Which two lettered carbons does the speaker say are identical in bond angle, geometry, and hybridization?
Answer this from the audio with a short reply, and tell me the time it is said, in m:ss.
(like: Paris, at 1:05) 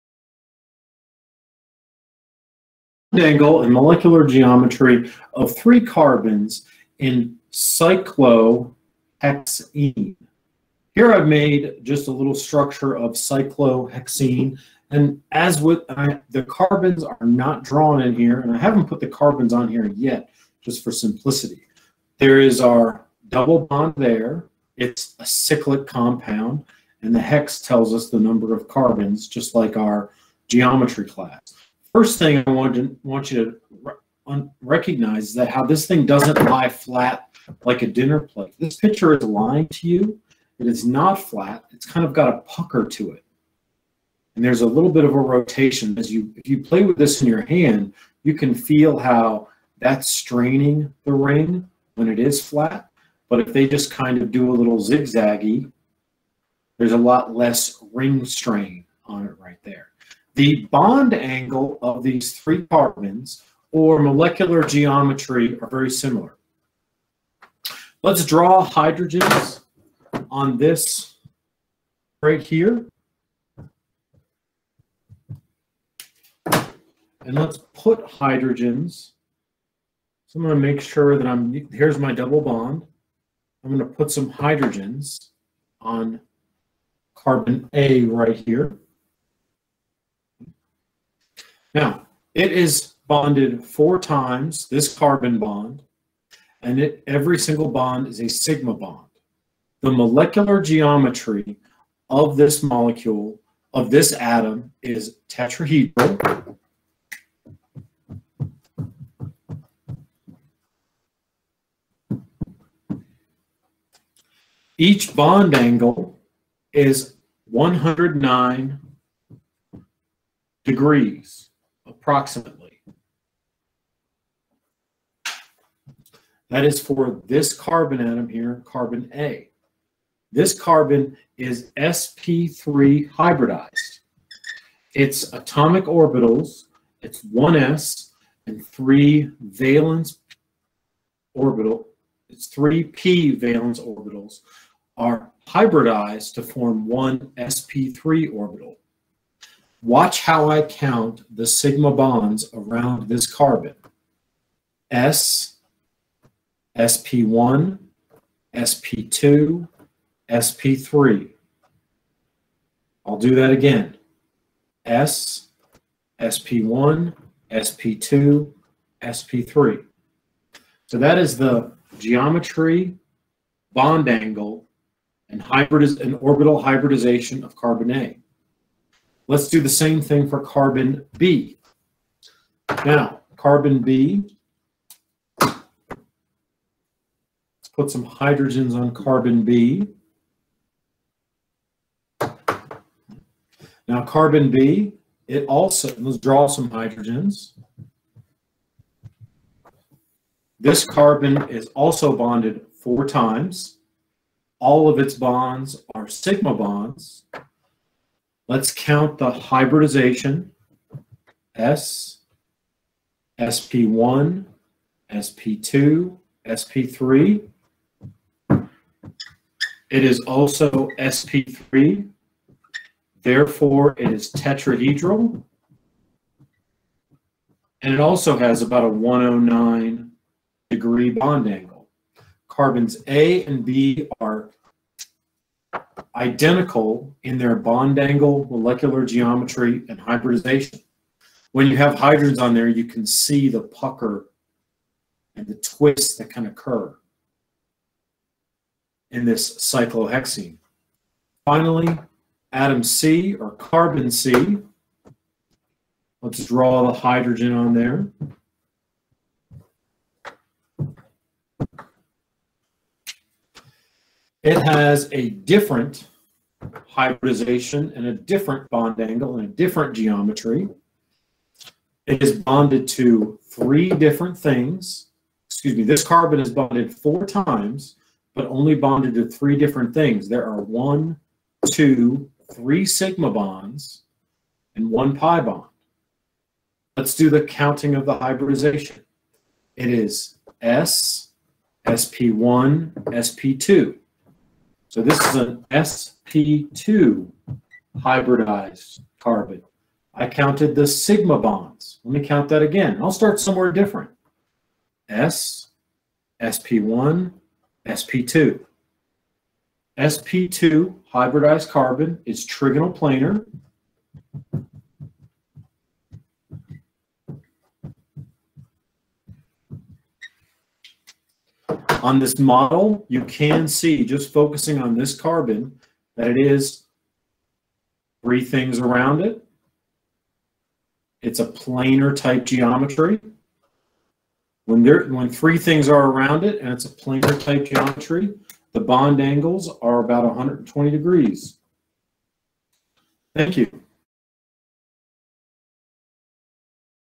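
A and B, at 3:52.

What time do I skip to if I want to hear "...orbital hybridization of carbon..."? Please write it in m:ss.
2:56.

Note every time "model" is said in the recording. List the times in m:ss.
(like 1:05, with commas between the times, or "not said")
5:22.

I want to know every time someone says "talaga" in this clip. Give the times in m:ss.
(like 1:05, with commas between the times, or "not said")
not said.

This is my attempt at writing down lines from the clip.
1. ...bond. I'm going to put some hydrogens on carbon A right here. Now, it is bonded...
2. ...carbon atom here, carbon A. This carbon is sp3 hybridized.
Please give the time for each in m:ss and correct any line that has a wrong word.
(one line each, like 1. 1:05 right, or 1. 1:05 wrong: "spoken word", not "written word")
1. 1:22 right
2. 2:07 right.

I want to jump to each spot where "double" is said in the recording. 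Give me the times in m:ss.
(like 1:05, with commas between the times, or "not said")
0:23, 1:22.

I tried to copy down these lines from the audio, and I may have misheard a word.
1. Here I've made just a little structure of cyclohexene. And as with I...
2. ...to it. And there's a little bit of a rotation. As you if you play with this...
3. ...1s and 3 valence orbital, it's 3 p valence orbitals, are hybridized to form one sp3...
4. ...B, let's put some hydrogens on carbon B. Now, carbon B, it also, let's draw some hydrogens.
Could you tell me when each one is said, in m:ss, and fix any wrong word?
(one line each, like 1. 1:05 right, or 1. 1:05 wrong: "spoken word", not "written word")
1. 0:10 right
2. 0:42 right
3. 2:17 right
4. 3:03 right.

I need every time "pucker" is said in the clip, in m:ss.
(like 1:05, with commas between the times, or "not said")
0:42, 4:03.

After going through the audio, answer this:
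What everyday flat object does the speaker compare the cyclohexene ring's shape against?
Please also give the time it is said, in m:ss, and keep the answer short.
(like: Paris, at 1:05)
A dinner plate, at 0:37.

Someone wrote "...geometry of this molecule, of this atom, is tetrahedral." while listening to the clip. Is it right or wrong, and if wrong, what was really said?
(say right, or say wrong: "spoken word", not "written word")
right.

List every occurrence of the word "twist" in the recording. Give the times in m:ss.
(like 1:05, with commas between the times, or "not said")
4:05.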